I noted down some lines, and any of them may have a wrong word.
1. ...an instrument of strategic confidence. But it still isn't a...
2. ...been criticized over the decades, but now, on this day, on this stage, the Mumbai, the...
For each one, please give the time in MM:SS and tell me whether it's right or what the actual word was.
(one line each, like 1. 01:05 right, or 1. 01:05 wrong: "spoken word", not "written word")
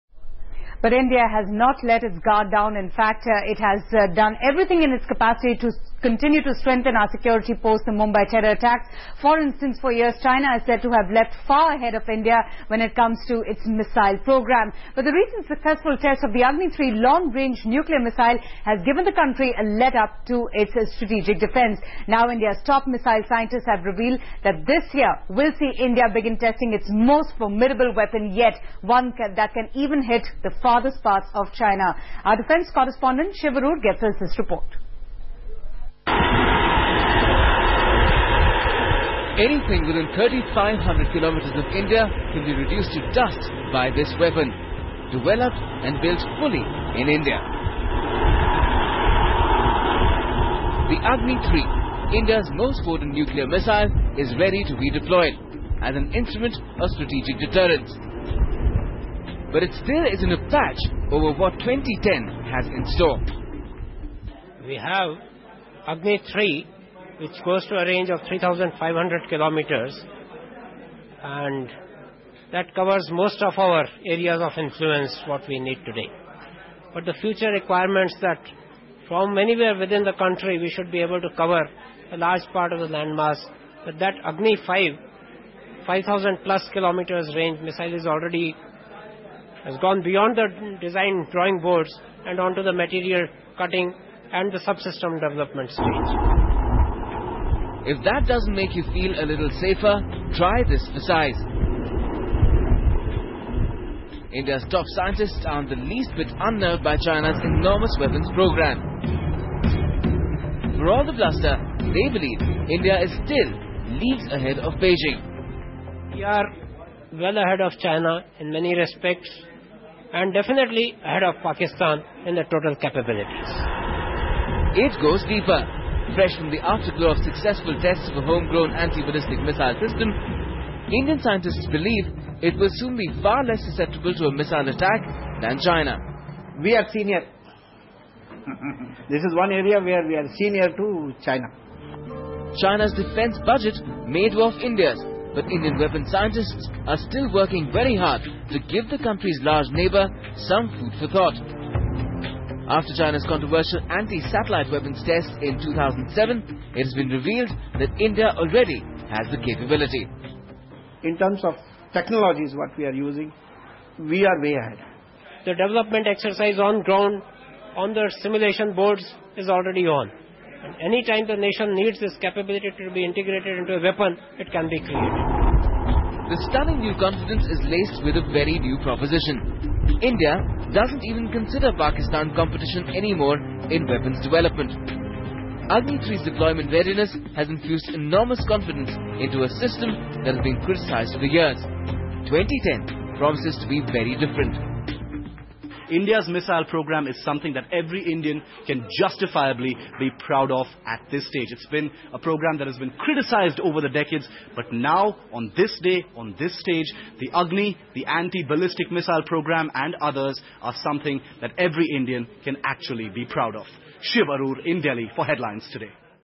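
1. 00:55 wrong: "deterrence", not "confidence"
2. 03:22 wrong: "Agni", not "Mumbai".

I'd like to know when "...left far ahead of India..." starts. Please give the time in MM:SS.
00:11.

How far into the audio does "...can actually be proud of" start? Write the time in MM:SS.
03:32.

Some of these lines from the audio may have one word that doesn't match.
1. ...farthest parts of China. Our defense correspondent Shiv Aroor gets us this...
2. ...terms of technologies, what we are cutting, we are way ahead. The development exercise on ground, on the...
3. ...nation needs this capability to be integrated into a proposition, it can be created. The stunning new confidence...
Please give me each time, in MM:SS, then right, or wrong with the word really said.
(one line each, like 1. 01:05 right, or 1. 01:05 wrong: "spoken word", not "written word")
1. 00:30 right
2. 02:41 wrong: "using", not "cutting"
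3. 02:51 wrong: "weapon", not "proposition".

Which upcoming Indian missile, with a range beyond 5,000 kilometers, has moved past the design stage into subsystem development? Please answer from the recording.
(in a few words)
Agni 5.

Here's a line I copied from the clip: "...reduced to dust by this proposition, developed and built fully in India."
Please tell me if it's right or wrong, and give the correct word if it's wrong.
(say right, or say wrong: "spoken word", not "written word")
wrong: "weapon", not "proposition".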